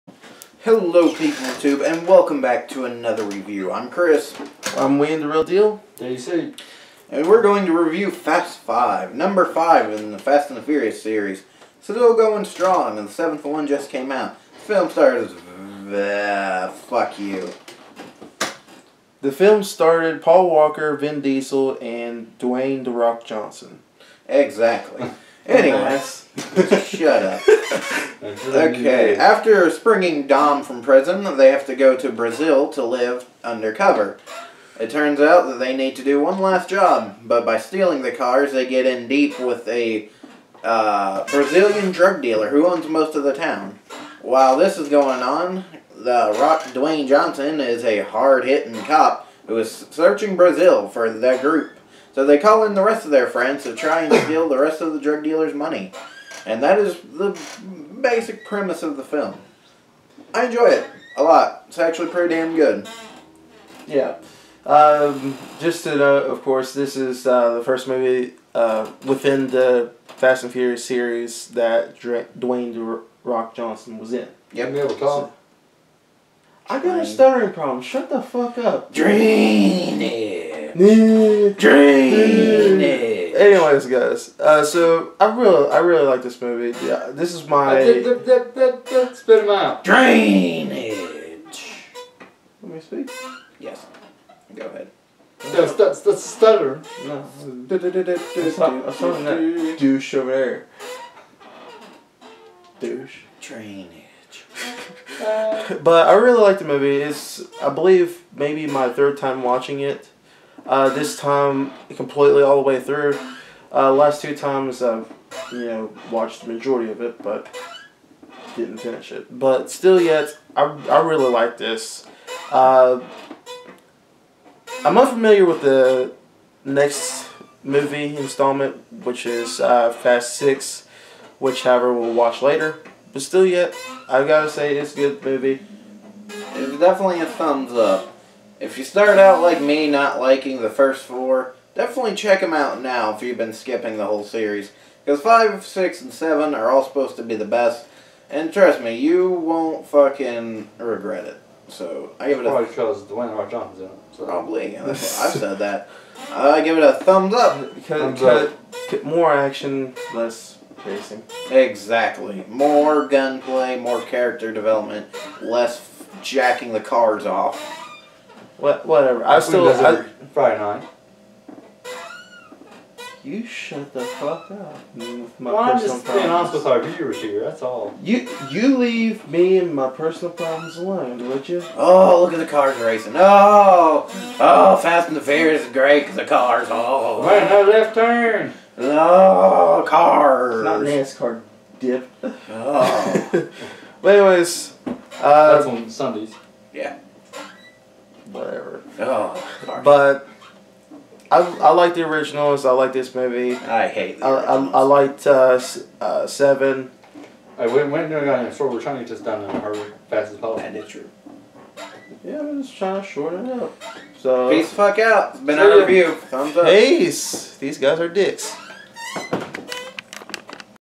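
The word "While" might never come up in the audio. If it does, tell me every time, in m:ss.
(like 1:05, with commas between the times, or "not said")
0:44.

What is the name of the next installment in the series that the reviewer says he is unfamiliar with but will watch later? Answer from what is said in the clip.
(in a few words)
Fast Six.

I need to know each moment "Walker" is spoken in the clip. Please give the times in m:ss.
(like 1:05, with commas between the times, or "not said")
0:20.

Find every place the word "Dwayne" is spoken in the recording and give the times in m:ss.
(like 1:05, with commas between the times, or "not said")
0:22, 0:46, 1:12, 2:33.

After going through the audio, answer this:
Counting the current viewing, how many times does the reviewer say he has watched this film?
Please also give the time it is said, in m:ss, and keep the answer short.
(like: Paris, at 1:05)
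third time, at 1:48.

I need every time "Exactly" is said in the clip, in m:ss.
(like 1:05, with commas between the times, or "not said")
0:24, 2:41.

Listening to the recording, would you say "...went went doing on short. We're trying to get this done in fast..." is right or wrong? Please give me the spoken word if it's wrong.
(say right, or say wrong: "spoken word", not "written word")
right.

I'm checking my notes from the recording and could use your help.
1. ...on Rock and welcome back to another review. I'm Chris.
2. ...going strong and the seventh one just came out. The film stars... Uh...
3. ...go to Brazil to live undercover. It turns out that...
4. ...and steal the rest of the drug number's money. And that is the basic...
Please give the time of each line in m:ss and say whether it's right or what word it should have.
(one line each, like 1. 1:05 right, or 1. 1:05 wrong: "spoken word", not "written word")
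1. 0:01 wrong: "YouTube", not "Rock"
2. 0:12 right
3. 0:31 right
4. 0:54 wrong: "dealer", not "number".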